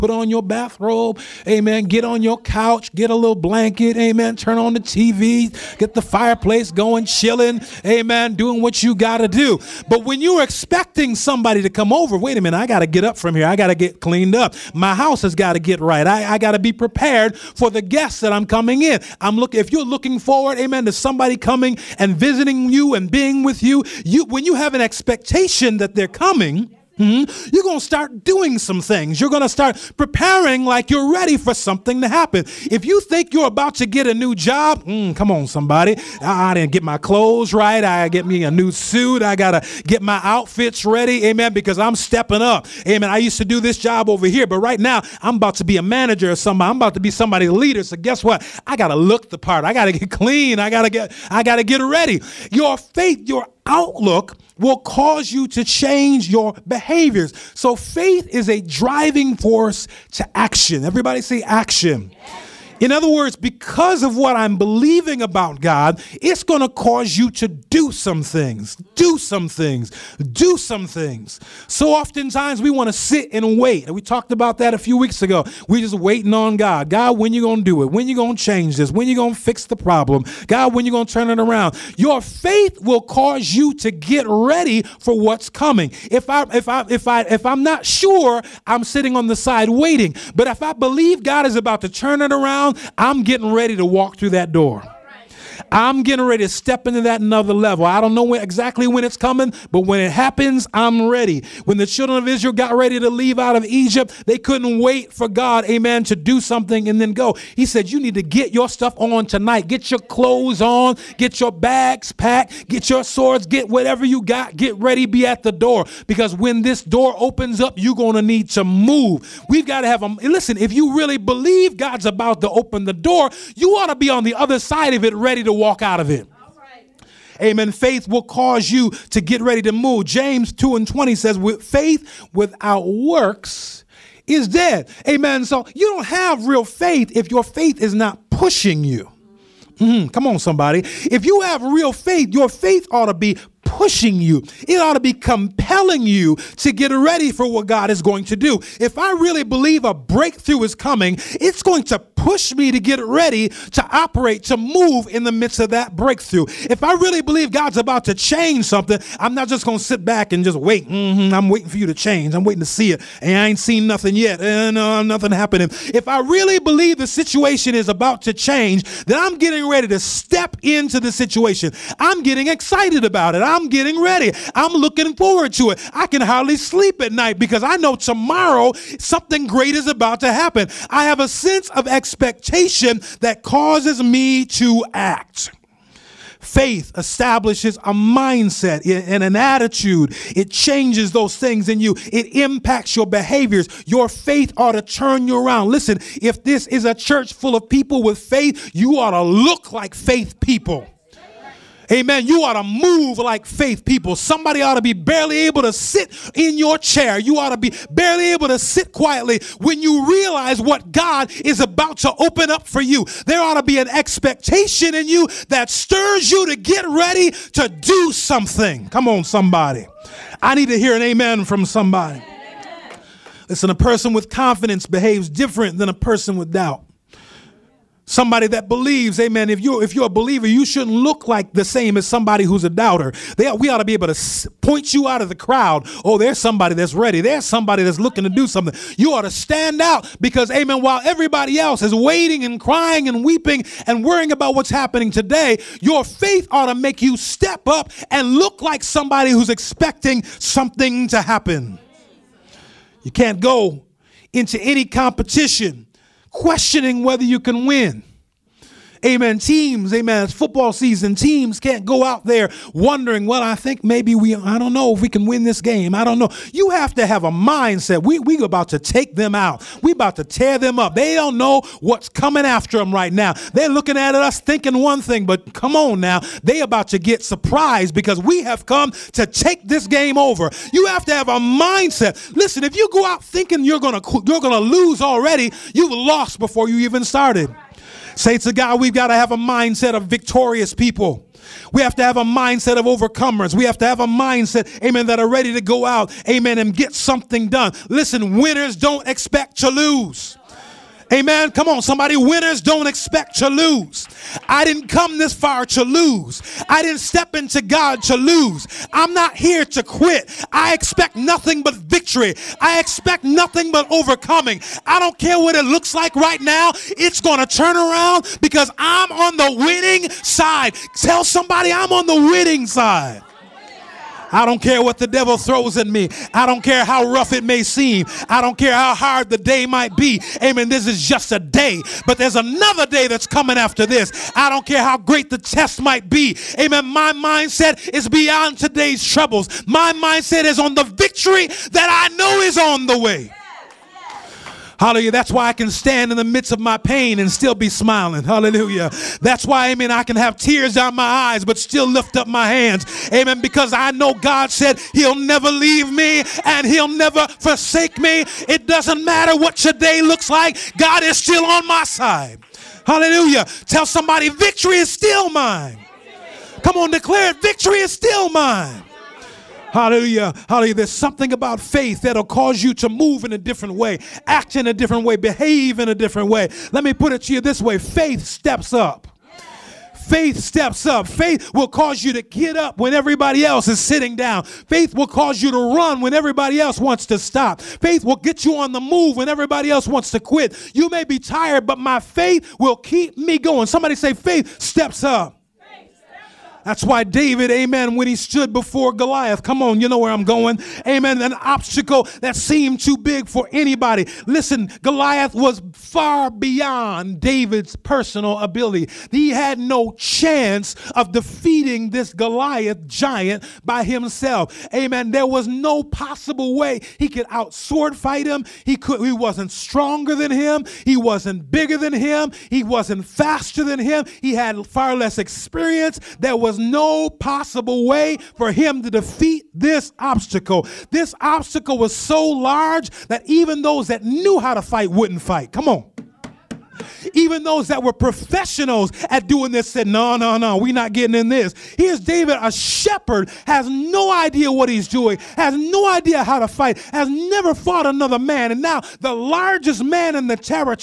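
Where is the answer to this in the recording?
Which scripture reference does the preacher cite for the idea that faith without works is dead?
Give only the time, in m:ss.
2:10.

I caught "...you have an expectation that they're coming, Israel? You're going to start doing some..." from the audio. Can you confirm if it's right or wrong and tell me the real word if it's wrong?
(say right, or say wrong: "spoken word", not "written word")
wrong: "Hmm", not "Israel".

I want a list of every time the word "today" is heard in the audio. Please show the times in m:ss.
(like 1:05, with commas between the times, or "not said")
4:05, 5:38.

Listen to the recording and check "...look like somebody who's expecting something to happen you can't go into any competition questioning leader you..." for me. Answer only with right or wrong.
wrong.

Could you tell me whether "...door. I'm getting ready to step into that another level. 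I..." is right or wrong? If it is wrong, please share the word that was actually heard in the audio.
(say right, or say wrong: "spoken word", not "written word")
right.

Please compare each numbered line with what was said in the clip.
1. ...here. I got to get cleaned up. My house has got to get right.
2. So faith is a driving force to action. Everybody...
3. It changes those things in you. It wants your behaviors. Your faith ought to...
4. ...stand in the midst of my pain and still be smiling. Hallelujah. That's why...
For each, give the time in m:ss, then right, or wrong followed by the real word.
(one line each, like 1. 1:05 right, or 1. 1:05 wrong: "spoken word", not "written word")
1. 0:13 right
2. 0:57 right
3. 3:10 wrong: "impacts", not "wants"
4. 5:45 right.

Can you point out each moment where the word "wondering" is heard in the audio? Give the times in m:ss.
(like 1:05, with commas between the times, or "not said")
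4:22.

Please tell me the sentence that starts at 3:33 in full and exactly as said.
There ought to be an expectation in you that stirs you to get ready to do something.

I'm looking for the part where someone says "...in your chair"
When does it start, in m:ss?
3:26.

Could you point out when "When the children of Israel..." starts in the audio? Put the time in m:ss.
1:41.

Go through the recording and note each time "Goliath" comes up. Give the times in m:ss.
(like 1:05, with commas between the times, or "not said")
6:38, 6:44, 6:52.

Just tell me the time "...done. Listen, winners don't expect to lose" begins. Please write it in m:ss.
4:57.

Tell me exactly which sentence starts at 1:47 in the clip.
He said, You need to get your stuff on tonight.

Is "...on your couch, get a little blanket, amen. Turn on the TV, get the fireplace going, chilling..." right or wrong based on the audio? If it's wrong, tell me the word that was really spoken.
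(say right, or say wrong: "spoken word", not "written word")
right.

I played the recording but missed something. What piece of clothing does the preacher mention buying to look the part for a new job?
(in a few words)
A new suit.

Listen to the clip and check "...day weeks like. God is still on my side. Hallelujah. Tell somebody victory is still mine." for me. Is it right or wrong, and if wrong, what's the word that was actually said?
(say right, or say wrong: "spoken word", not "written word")
wrong: "looks", not "weeks".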